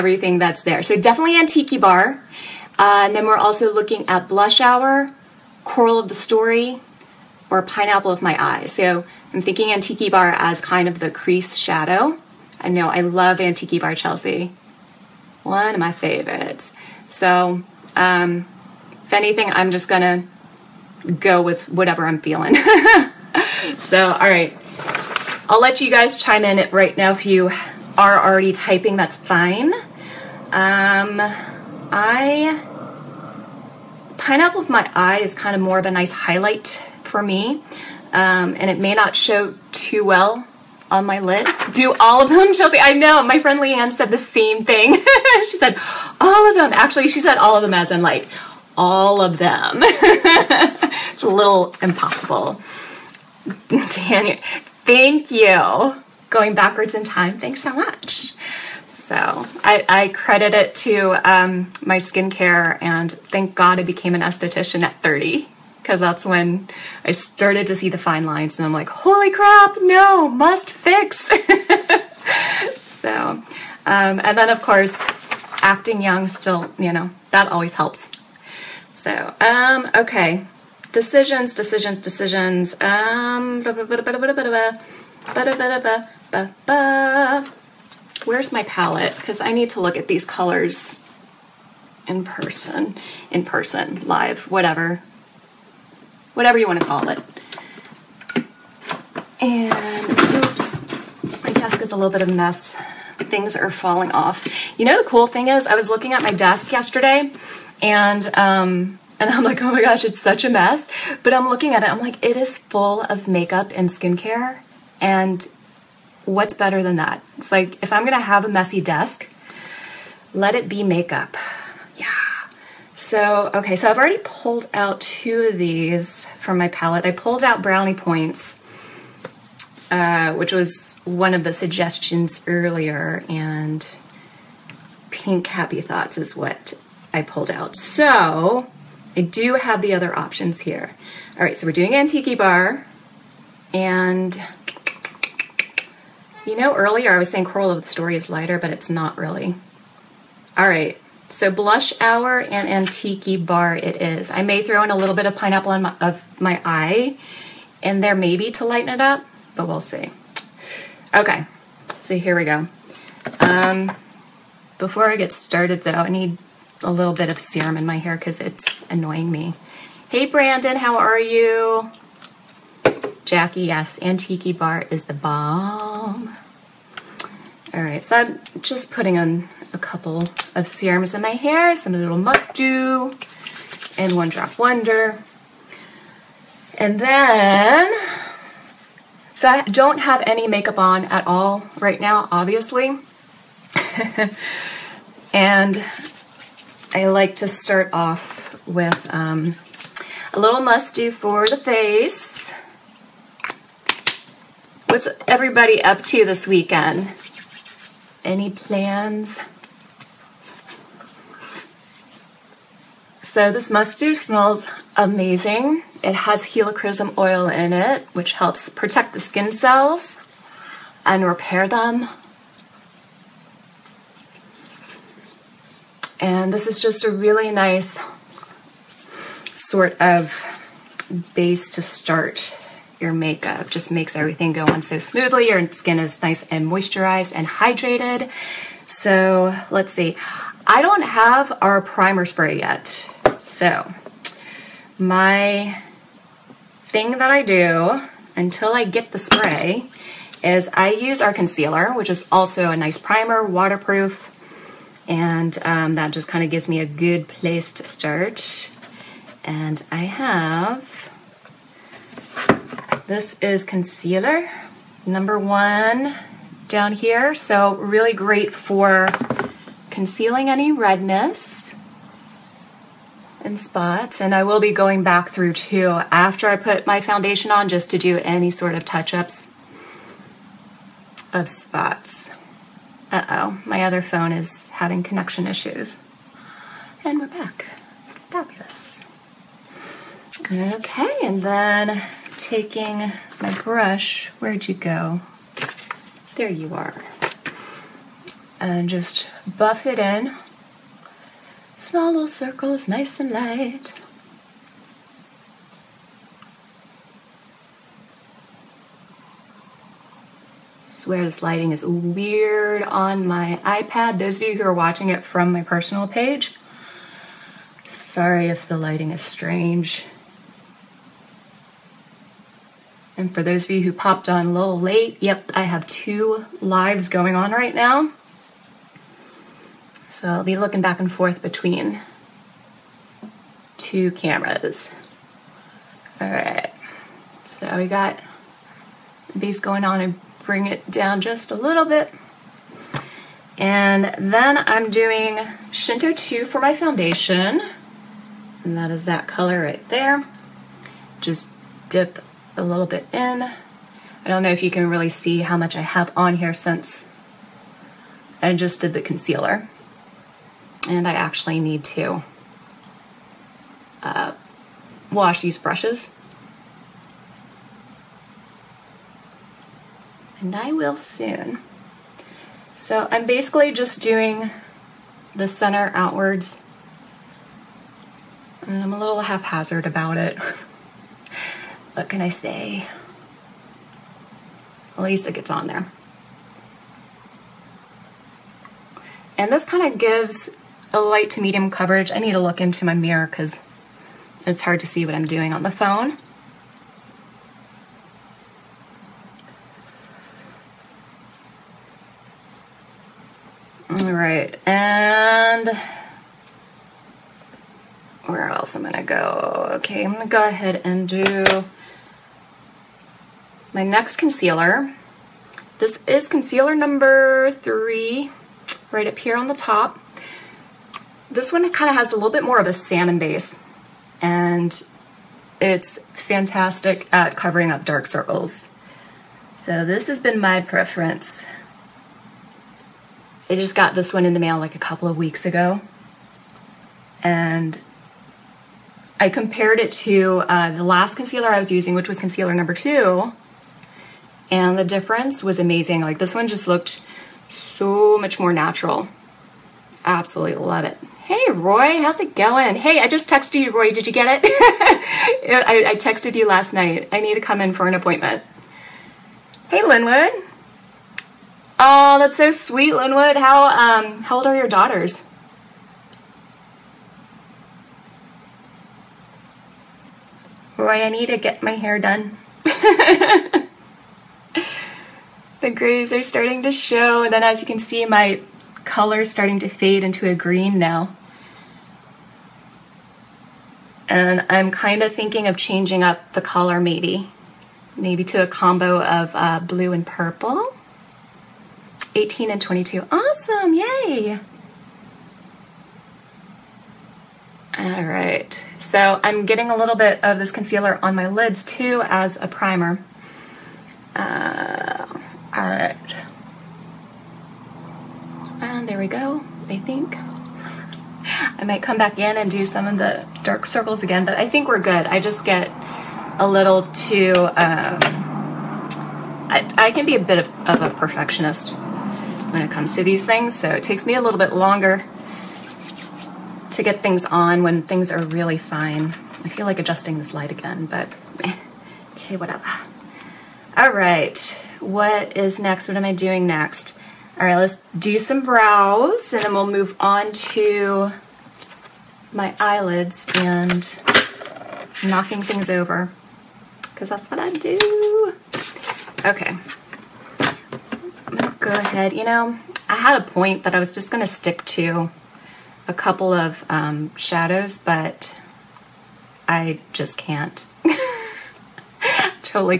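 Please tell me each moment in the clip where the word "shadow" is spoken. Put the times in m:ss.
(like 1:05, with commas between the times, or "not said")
0:11, 9:17.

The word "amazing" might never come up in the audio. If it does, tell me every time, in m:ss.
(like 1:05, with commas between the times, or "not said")
3:34, 7:25.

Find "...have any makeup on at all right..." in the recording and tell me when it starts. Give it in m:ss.
3:09.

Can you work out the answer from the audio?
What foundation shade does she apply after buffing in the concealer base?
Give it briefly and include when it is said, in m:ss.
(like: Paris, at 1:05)
Shinto 2, at 5:45.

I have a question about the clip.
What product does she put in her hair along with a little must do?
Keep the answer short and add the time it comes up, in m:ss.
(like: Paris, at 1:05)
one drop wonder, at 3:04.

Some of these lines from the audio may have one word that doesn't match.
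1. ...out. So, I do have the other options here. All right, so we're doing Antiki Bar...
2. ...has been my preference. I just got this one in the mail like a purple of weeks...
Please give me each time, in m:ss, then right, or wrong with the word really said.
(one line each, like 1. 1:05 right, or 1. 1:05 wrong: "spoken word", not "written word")
1. 2:17 right
2. 7:10 wrong: "couple", not "purple".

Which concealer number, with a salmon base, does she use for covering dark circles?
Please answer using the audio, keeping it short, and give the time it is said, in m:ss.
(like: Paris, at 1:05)
3, at 6:57.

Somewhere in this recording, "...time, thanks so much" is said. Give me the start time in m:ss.
0:57.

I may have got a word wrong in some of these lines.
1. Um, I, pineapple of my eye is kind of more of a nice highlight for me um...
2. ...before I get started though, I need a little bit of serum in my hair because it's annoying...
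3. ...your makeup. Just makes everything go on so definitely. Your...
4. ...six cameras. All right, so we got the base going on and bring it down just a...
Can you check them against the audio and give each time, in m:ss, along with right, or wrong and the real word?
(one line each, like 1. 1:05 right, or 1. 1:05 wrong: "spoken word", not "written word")
1. 0:30 right
2. 2:44 right
3. 3:52 wrong: "smoothly", not "definitely"
4. 5:33 wrong: "two", not "six".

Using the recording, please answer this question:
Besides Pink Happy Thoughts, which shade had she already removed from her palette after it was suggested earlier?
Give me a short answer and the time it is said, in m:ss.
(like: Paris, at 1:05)
Brownie Points, at 2:07.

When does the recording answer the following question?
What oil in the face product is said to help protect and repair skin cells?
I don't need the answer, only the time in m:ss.
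3:36.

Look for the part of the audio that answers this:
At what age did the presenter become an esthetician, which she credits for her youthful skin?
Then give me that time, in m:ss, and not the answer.
1:05.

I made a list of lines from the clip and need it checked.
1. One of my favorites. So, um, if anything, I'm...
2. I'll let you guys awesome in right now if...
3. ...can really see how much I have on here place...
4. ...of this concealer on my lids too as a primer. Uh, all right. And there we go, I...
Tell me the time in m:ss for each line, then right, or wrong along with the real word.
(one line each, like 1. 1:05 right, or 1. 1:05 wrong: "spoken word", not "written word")
1. 0:15 right
2. 0:25 wrong: "chime", not "awesome"
3. 5:54 wrong: "since", not "place"
4. 8:20 right.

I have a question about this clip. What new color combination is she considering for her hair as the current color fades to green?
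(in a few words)
blue and purple.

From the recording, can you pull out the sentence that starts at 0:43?
My friend Leanne said the same thing.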